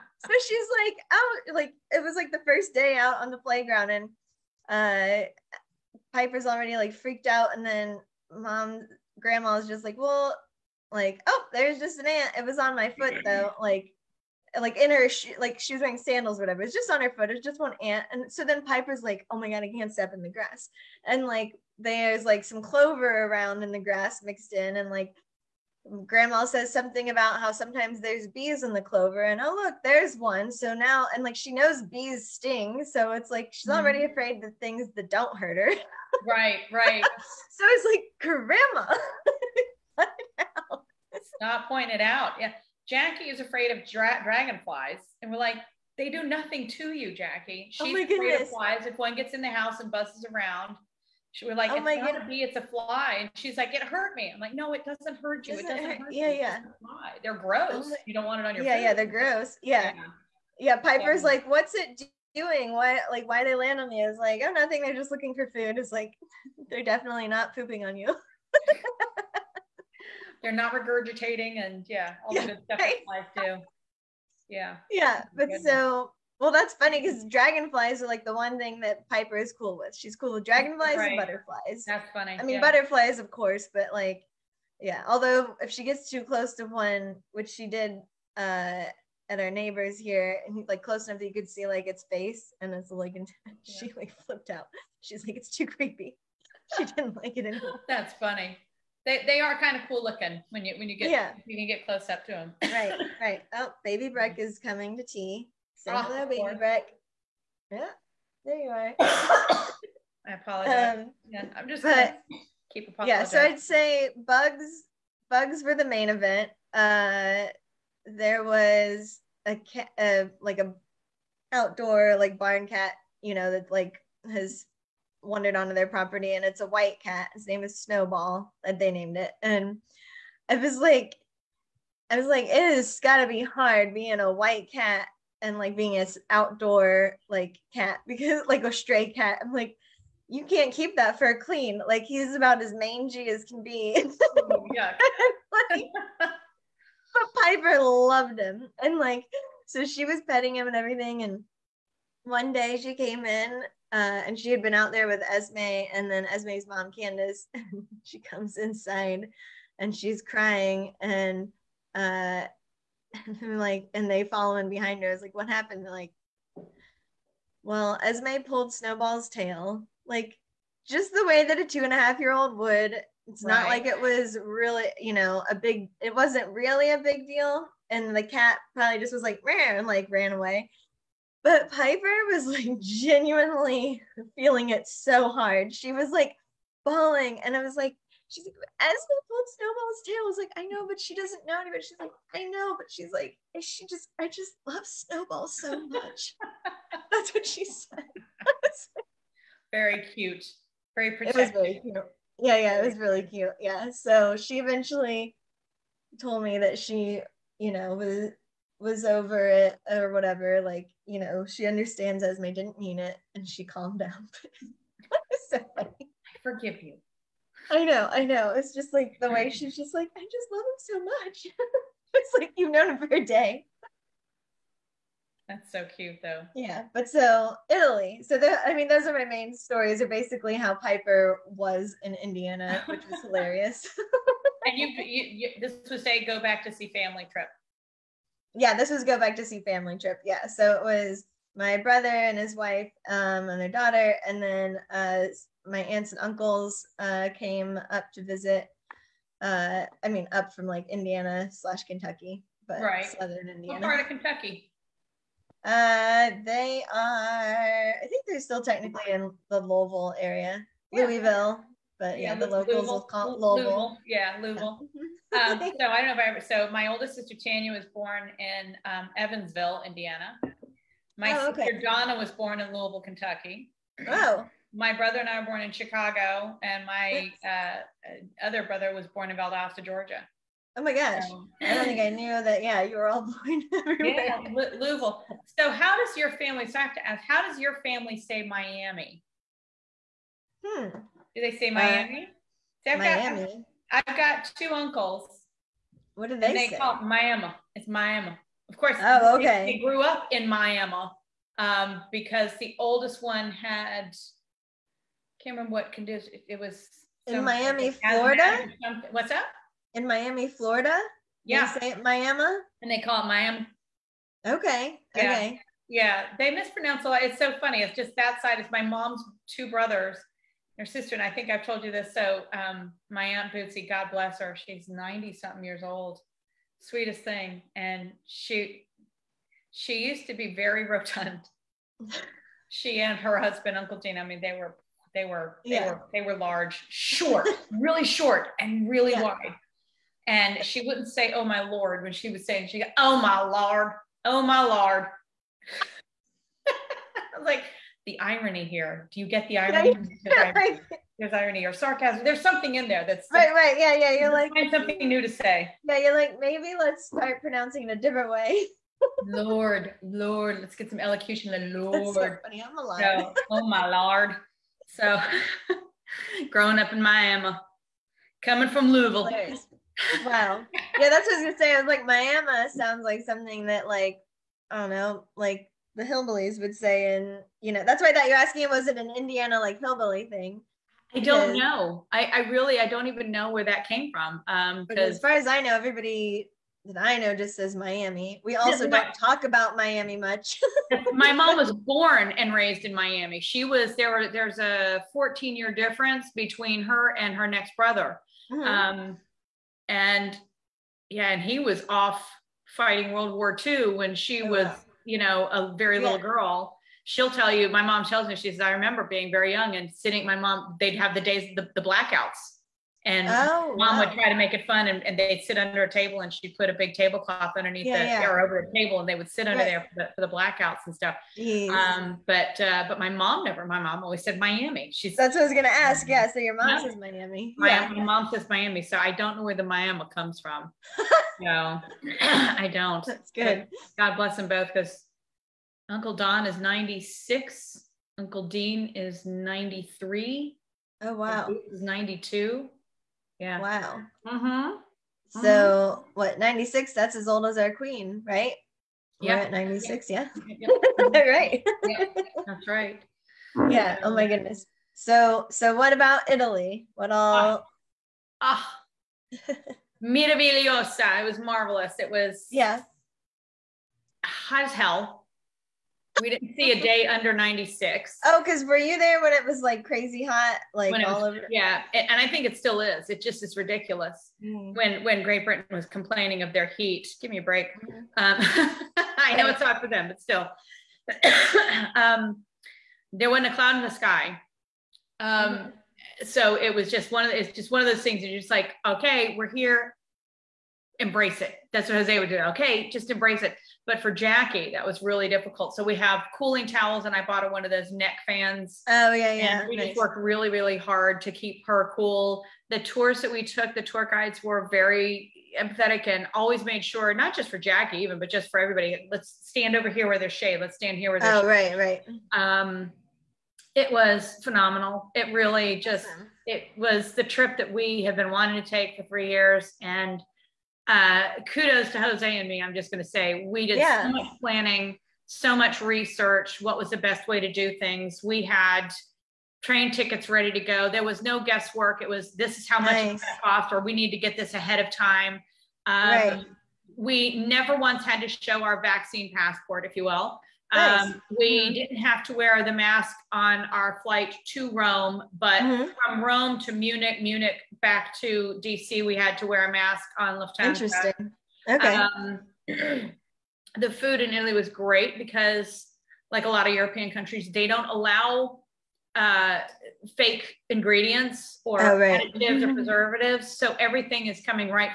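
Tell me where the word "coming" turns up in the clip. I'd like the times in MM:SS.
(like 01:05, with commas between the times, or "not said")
01:44, 06:08, 09:24.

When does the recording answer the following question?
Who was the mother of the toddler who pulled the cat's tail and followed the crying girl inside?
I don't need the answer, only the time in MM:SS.
02:36.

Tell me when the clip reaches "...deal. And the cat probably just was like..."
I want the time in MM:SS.
02:57.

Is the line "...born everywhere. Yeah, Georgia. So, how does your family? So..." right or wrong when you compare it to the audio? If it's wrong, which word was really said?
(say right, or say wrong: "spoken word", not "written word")
wrong: "Louisville", not "Georgia".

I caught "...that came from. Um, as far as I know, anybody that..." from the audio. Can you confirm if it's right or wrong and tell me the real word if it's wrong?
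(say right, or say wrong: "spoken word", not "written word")
wrong: "everybody", not "anybody".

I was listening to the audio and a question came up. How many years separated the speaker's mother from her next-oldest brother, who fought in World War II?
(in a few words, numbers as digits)
14.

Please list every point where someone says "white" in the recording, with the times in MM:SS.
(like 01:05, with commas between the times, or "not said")
02:06, 02:14.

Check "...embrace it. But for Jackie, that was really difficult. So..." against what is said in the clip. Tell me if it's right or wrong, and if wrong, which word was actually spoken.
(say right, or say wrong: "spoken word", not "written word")
right.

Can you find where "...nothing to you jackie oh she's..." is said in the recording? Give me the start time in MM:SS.
00:46.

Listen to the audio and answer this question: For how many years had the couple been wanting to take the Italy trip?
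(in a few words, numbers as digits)
3.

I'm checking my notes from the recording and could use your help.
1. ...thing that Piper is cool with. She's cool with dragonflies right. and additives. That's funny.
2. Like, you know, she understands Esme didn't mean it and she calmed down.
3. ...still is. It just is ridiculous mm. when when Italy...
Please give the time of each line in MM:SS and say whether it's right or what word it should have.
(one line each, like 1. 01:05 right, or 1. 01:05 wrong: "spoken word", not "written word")
1. 01:18 wrong: "butterflies", not "additives"
2. 03:30 right
3. 07:52 wrong: "Great", not "Italy".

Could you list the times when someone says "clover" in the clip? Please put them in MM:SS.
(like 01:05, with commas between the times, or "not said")
00:22, 00:28.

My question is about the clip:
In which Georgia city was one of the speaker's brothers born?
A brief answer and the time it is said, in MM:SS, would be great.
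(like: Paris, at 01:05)
Valdosta, at 04:39.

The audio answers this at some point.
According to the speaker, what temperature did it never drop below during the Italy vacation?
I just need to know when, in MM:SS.
07:47.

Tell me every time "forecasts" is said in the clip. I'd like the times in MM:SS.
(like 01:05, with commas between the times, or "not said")
not said.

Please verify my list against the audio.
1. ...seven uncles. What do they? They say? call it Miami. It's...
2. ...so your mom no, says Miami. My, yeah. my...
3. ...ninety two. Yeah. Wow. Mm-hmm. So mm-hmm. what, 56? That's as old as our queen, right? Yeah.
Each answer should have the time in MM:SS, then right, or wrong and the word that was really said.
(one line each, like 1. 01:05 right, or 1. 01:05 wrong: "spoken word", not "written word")
1. 04:54 wrong: "two", not "seven"
2. 07:06 right
3. 07:21 wrong: "96", not "56".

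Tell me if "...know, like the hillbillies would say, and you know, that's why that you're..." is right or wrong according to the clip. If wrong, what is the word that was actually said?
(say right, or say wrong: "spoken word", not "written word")
right.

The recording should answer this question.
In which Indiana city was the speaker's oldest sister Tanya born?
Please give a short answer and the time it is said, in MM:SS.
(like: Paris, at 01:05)
Evansville, at 04:29.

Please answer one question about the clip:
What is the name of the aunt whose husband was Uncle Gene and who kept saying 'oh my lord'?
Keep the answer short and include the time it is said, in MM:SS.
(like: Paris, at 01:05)
Bootsy, at 05:23.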